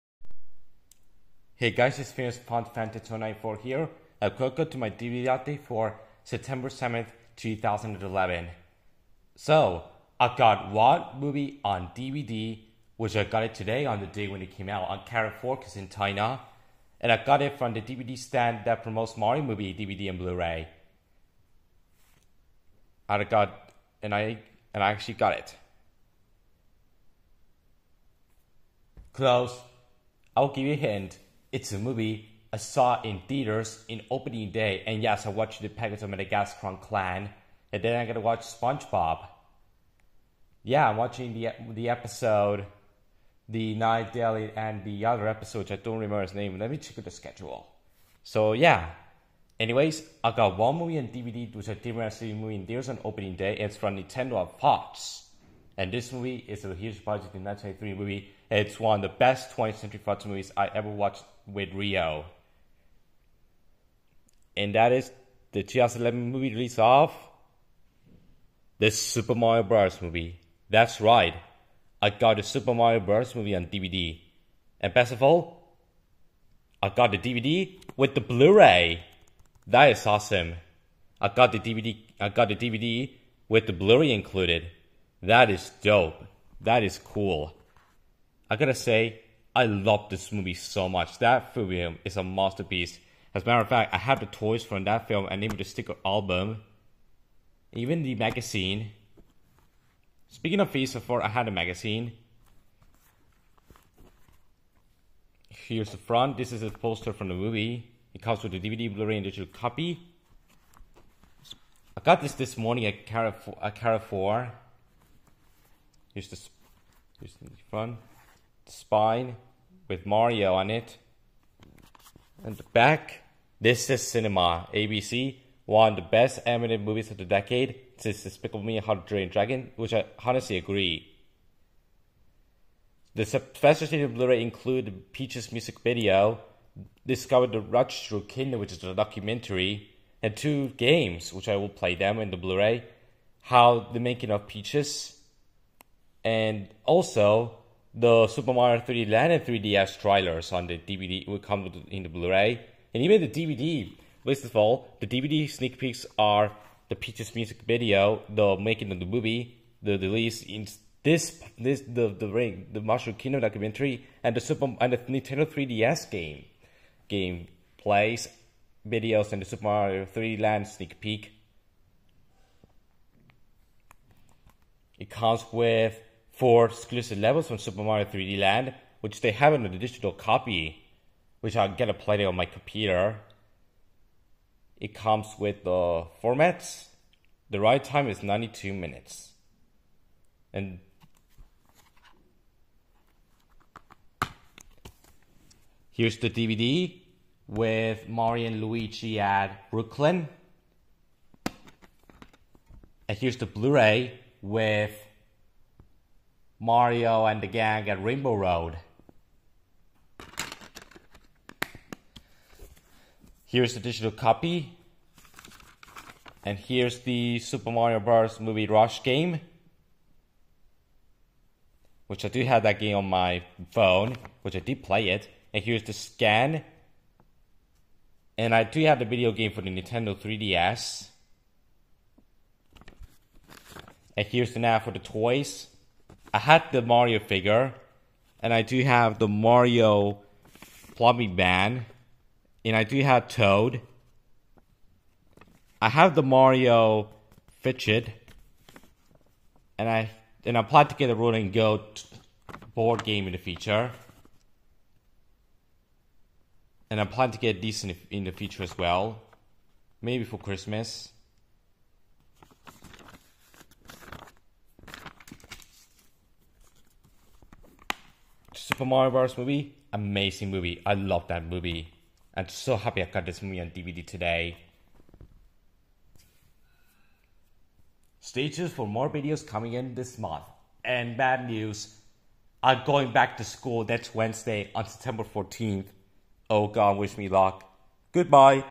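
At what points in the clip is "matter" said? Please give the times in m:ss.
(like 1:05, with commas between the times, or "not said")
1:33.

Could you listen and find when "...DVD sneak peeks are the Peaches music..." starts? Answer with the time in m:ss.
2:35.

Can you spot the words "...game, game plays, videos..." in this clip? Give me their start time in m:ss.
2:46.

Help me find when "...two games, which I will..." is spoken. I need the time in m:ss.
2:20.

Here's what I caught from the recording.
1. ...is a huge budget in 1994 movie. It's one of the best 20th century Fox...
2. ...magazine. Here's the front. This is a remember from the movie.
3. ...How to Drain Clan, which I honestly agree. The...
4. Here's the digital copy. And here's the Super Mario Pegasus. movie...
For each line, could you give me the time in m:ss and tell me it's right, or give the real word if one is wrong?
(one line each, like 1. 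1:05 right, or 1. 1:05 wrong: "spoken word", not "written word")
1. 0:56 wrong: "1993", not "1994"
2. 1:41 wrong: "poster", not "remember"
3. 2:08 wrong: "Dragon", not "Clan"
4. 3:33 wrong: "Bros", not "Pegasus".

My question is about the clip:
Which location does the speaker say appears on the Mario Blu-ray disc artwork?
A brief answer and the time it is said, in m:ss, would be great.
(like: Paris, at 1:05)
Rainbow Road, at 3:28.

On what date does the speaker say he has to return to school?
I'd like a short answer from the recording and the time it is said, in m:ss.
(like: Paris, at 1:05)
September 14th, at 4:44.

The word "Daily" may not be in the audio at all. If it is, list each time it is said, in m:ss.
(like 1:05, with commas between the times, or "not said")
0:44.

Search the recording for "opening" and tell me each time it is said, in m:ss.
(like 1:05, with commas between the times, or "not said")
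0:34, 0:53.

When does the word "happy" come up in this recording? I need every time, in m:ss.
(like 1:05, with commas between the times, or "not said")
4:32.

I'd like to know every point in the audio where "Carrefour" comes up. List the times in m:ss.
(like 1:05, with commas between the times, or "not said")
0:15, 1:53.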